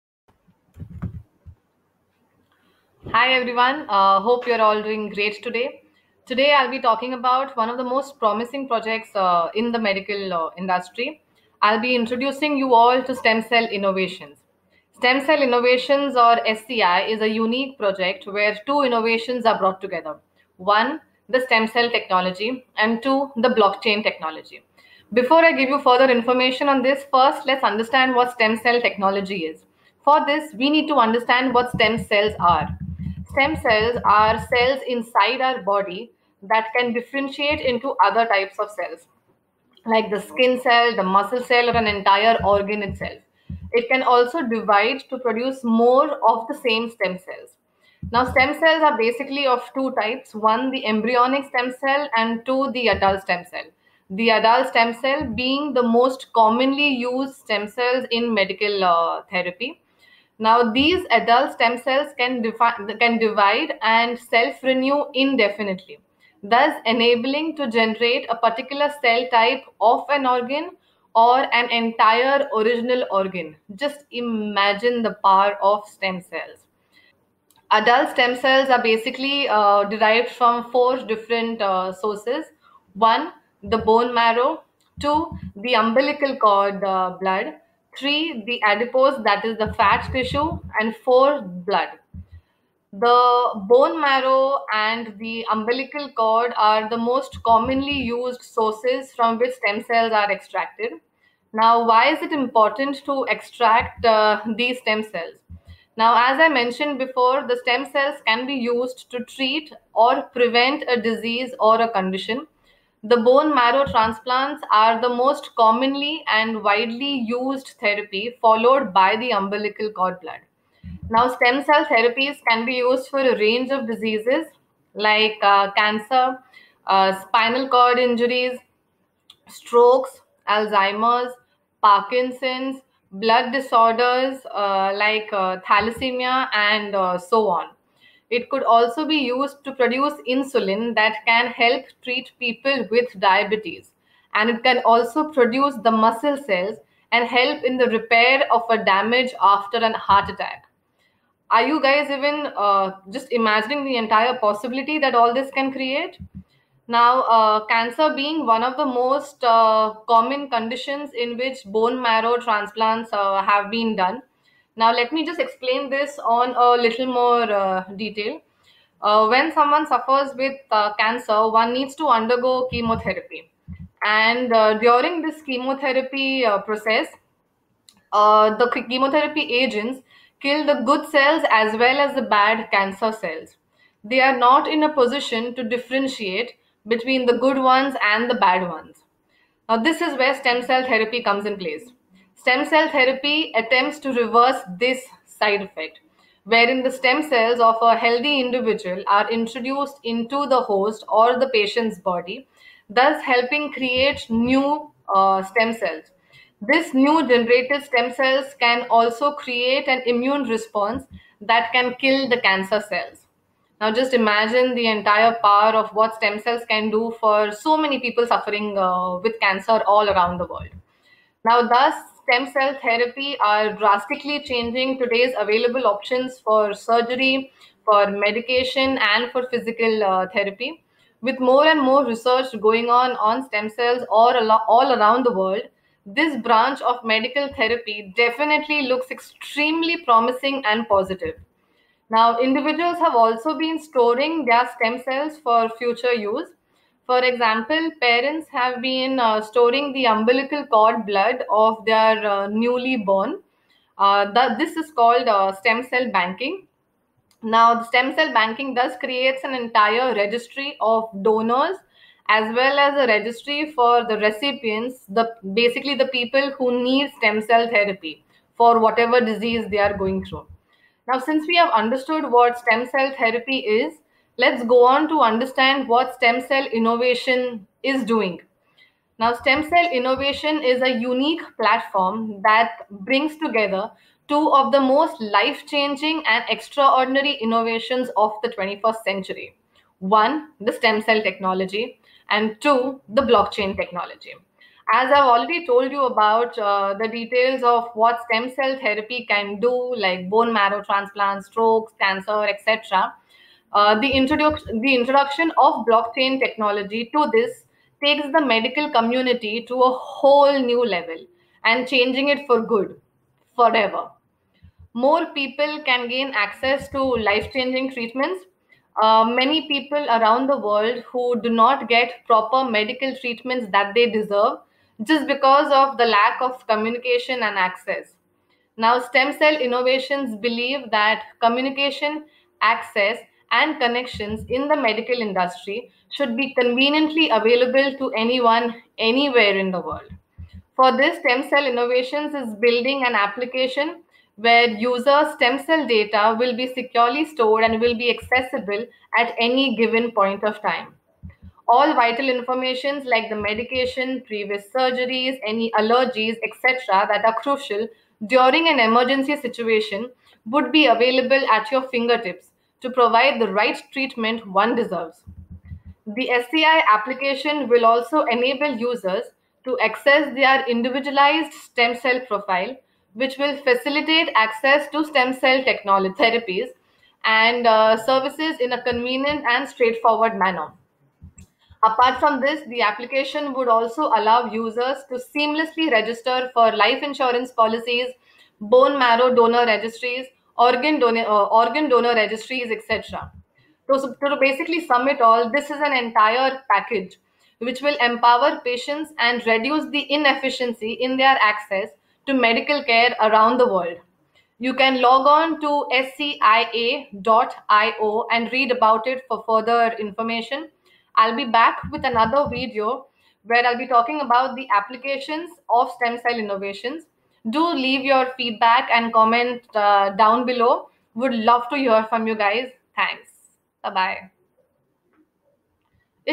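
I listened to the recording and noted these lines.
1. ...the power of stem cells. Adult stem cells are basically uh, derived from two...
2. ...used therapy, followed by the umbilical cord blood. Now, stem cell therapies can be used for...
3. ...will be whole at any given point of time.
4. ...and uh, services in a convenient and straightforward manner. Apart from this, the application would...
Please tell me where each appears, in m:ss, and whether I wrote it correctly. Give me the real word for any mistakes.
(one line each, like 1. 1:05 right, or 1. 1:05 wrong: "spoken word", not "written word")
1. 1:15 wrong: "four", not "two"
2. 1:57 right
3. 5:47 wrong: "accessible", not "whole"
4. 6:17 right.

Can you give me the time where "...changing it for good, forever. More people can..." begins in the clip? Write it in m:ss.
5:11.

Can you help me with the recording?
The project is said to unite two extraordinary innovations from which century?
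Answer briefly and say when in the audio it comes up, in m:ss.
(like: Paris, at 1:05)
21st century, at 4:48.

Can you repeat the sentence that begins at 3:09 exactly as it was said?
Now, this is where stem cell therapy comes in place.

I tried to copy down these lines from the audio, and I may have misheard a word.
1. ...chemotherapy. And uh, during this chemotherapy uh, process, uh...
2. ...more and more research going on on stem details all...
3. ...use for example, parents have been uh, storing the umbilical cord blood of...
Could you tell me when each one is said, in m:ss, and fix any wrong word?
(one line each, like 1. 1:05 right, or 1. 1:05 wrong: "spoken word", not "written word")
1. 2:52 right
2. 3:51 wrong: "cells", not "details"
3. 4:06 right.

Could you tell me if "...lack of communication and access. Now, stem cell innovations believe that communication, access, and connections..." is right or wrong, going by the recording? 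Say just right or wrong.
right.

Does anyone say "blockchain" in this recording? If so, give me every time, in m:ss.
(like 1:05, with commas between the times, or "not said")
0:23, 4:53, 5:05.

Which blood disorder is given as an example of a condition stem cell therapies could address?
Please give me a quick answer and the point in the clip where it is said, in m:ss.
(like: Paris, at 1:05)
thalassemia, at 2:15.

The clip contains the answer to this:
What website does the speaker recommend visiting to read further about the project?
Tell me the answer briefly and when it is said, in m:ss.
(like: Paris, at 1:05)
scia.io, at 6:45.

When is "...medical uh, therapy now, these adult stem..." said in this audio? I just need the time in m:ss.
0:58.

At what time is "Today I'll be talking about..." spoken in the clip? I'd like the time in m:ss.
0:06.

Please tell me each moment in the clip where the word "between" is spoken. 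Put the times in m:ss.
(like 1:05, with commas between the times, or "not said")
3:06.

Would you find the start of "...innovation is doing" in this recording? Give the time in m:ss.
4:36.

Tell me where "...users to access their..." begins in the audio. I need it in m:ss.
6:08.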